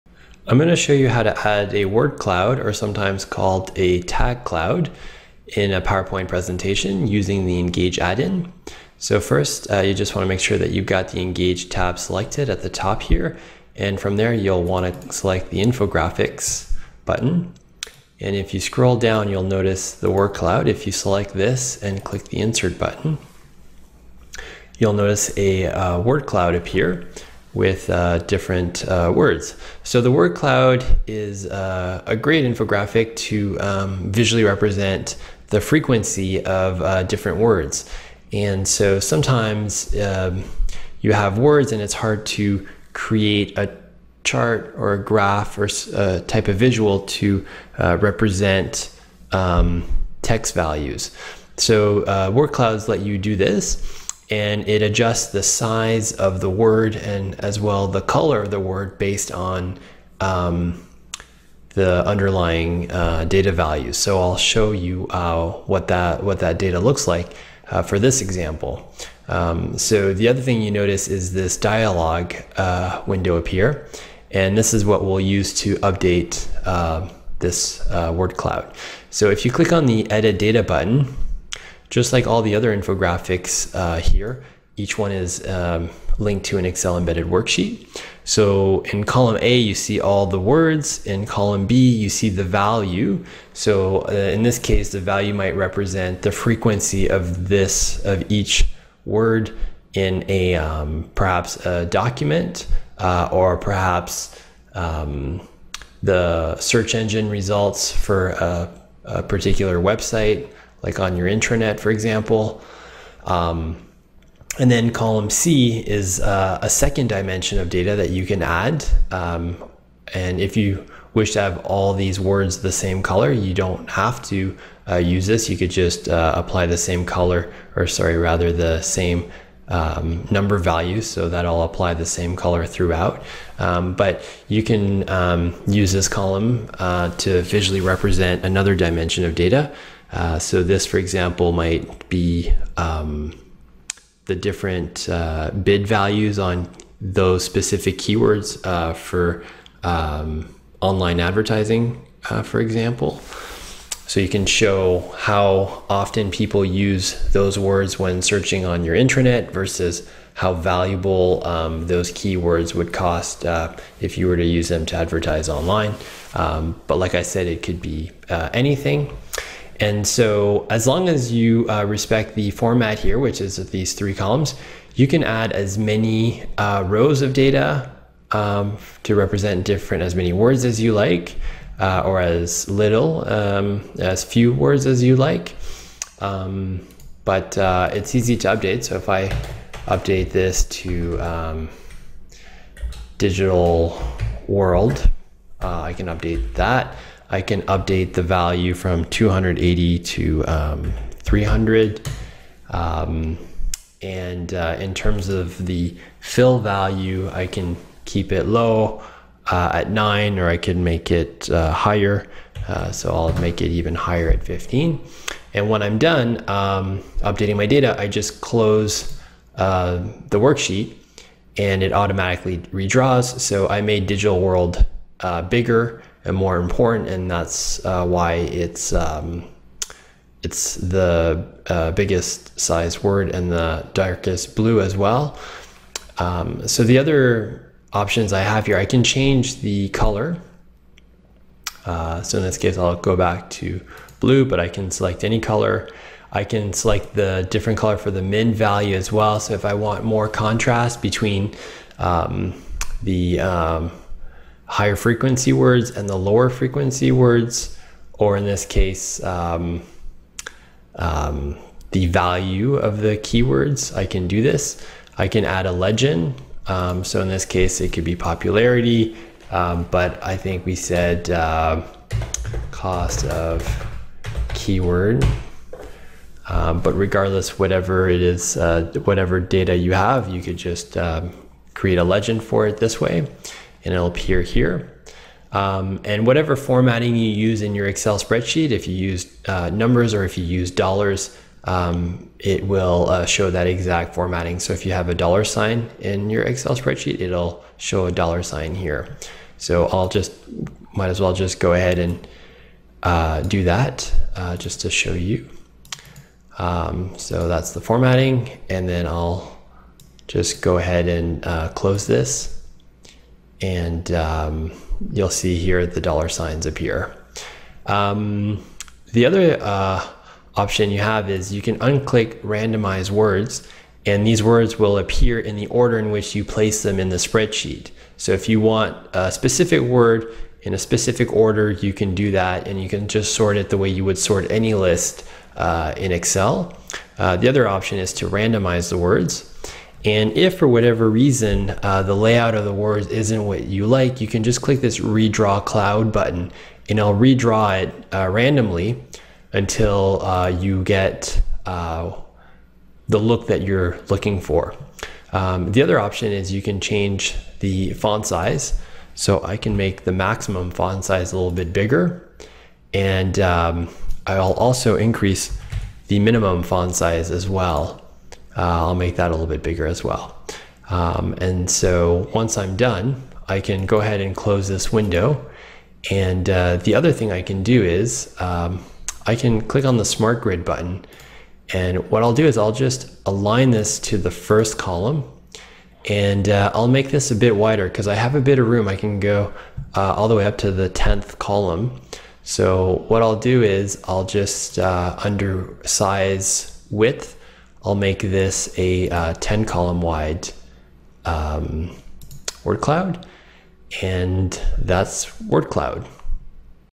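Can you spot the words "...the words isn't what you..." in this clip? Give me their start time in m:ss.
5:42.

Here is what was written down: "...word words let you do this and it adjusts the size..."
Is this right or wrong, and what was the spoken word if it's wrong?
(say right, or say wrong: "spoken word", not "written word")
wrong: "clouds", not "words".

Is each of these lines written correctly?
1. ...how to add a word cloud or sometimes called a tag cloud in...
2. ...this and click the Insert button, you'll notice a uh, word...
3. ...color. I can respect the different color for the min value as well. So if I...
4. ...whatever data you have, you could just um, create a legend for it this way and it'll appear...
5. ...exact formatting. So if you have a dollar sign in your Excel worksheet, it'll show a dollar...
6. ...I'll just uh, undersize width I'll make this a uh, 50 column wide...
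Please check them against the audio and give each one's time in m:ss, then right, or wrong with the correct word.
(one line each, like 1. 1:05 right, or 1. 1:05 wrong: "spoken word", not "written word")
1. 0:01 right
2. 0:21 right
3. 4:05 wrong: "select", not "respect"
4. 4:39 right
5. 4:53 wrong: "spreadsheet", not "worksheet"
6. 6:34 wrong: "10", not "50".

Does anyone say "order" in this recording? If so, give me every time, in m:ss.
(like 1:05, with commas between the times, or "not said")
5:25, 5:31.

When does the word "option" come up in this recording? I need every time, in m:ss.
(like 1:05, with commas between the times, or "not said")
3:57, 5:20, 5:37, 5:55.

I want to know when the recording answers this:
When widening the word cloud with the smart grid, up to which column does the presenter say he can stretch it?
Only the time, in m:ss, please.
6:30.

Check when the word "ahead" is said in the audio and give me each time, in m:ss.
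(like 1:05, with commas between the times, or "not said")
5:01, 5:10, 6:14.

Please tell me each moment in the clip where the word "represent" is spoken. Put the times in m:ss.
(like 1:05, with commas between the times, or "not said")
0:34, 0:47, 1:35, 2:17, 2:59.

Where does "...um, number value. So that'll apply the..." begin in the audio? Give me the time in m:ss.
2:09.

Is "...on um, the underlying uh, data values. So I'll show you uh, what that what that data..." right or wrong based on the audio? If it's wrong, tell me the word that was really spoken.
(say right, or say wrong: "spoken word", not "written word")
right.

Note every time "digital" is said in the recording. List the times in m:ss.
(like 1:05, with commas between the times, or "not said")
3:13, 3:44.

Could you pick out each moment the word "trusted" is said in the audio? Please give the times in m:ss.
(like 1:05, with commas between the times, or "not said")
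not said.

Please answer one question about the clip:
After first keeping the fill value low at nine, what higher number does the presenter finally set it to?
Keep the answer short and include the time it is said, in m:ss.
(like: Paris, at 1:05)
15, at 3:34.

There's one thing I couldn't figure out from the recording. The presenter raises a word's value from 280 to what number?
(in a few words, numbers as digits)
300.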